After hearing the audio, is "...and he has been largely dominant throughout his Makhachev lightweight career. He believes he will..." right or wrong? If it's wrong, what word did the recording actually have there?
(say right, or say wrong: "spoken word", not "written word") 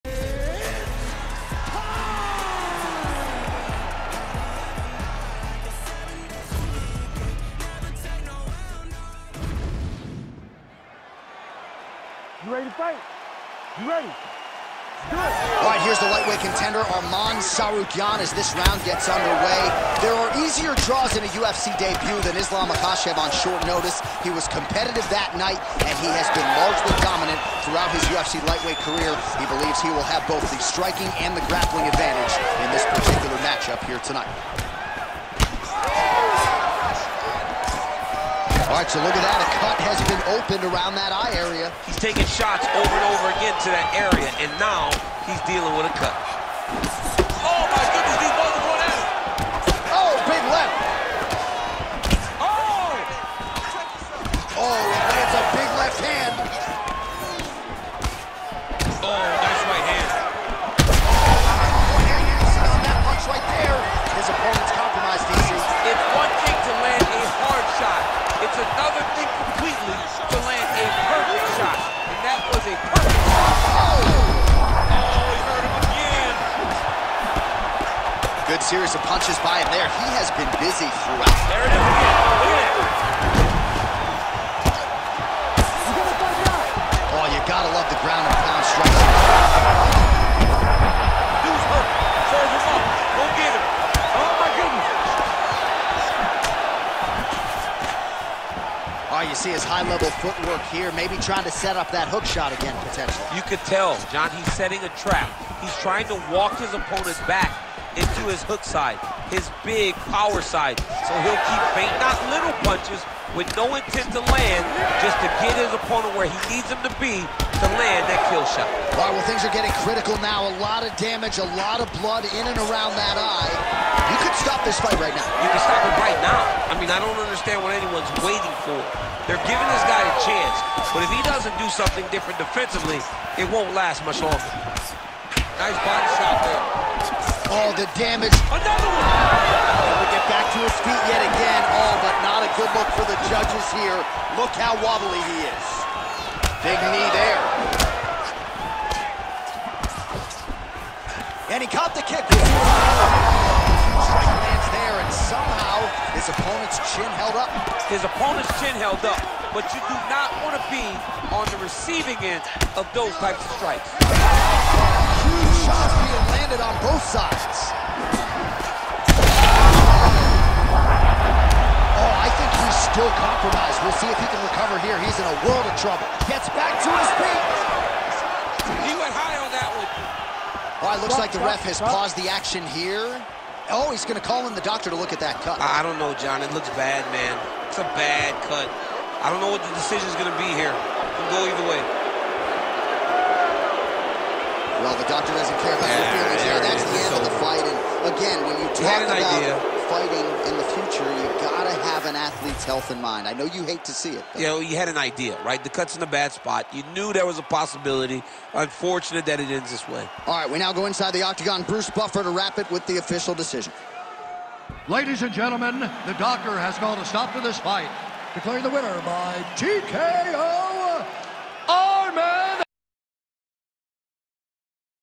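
wrong: "UFC", not "Makhachev".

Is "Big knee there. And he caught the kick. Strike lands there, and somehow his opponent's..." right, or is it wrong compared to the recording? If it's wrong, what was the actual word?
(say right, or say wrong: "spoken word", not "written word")
right.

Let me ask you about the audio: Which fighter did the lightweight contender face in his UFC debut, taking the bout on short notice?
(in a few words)
Islam Makhachev.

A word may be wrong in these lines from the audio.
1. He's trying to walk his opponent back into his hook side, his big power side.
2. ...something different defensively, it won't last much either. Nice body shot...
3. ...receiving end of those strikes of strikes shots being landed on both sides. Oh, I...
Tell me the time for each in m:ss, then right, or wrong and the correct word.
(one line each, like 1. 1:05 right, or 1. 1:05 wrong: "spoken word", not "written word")
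1. 1:45 right
2. 2:11 wrong: "longer", not "either"
3. 2:41 wrong: "types", not "strikes".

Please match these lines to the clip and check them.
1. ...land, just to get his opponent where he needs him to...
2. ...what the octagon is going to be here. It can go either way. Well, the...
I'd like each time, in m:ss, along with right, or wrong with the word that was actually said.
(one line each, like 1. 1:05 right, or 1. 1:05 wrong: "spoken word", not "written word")
1. 1:54 right
2. 3:09 wrong: "decision", not "octagon".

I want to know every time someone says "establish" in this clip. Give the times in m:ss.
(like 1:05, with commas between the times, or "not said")
not said.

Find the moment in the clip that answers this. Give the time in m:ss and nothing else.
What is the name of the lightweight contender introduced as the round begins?
0:16.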